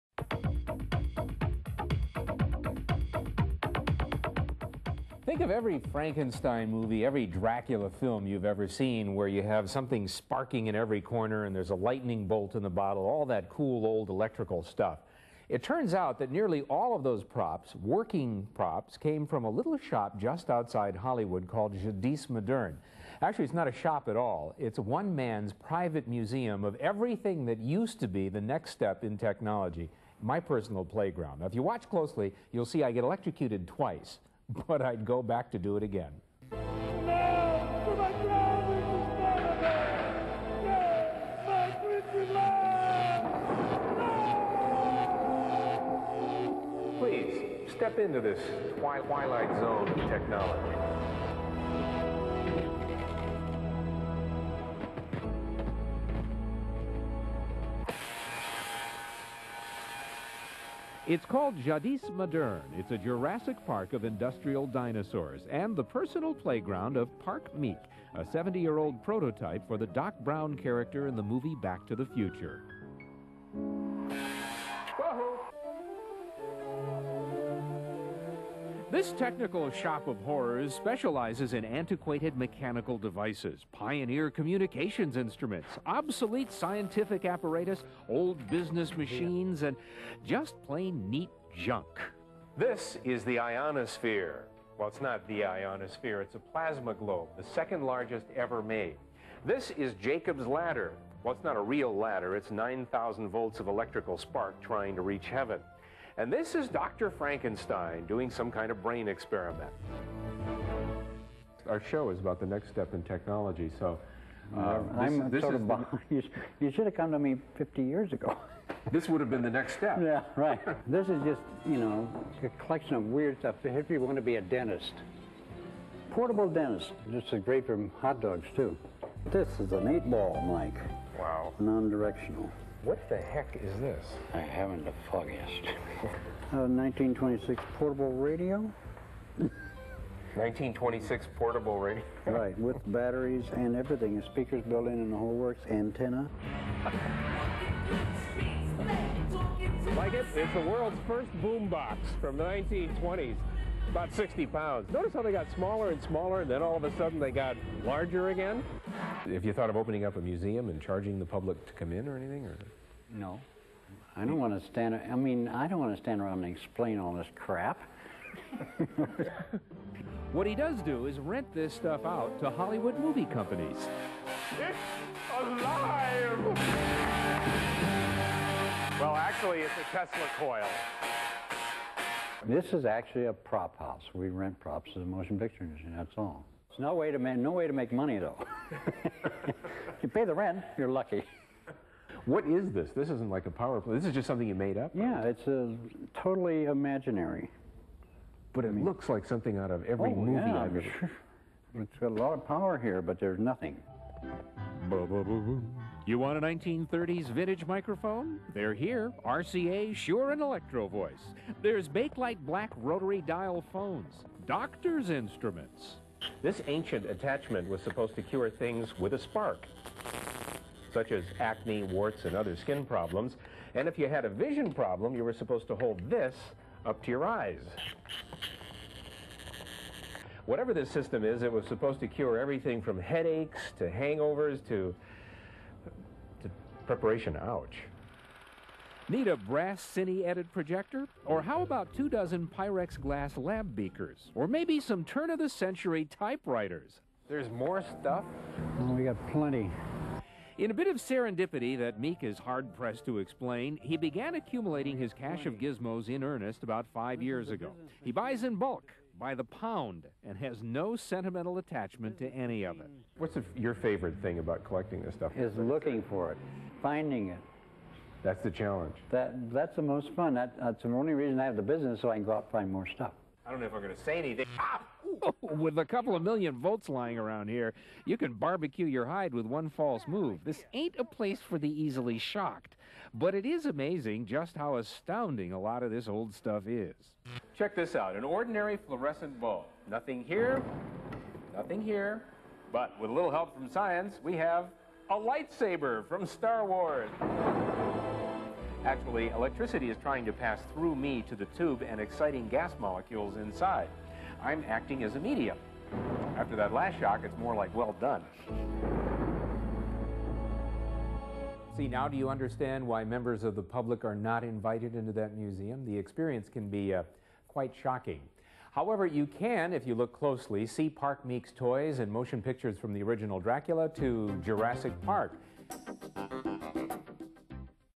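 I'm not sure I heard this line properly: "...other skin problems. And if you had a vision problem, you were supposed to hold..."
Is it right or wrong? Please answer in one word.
right.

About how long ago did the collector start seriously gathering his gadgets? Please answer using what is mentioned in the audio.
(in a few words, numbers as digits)
About five years ago.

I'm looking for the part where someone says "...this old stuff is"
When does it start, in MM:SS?
04:45.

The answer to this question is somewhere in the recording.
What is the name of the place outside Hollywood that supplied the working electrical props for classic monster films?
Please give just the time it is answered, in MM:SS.
00:21.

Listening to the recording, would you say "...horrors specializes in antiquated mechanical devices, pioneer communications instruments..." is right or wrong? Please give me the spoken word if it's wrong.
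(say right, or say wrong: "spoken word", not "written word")
right.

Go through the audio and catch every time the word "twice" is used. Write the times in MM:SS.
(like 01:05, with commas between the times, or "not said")
00:33.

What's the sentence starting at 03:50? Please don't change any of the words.
Whatever this system is, it was supposed to cure everything from headaches to hangovers to Preparation, ouch.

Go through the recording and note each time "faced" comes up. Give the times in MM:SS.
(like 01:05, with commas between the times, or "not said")
not said.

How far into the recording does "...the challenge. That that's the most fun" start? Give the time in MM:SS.
04:28.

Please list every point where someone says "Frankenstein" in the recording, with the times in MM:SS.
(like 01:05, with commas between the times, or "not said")
00:05, 01:47.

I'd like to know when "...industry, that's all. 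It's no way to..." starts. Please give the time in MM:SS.
03:05.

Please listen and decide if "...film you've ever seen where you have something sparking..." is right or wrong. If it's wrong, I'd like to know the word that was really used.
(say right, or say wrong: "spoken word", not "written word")
right.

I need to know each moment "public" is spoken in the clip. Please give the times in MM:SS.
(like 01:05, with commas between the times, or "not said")
02:41, 05:13.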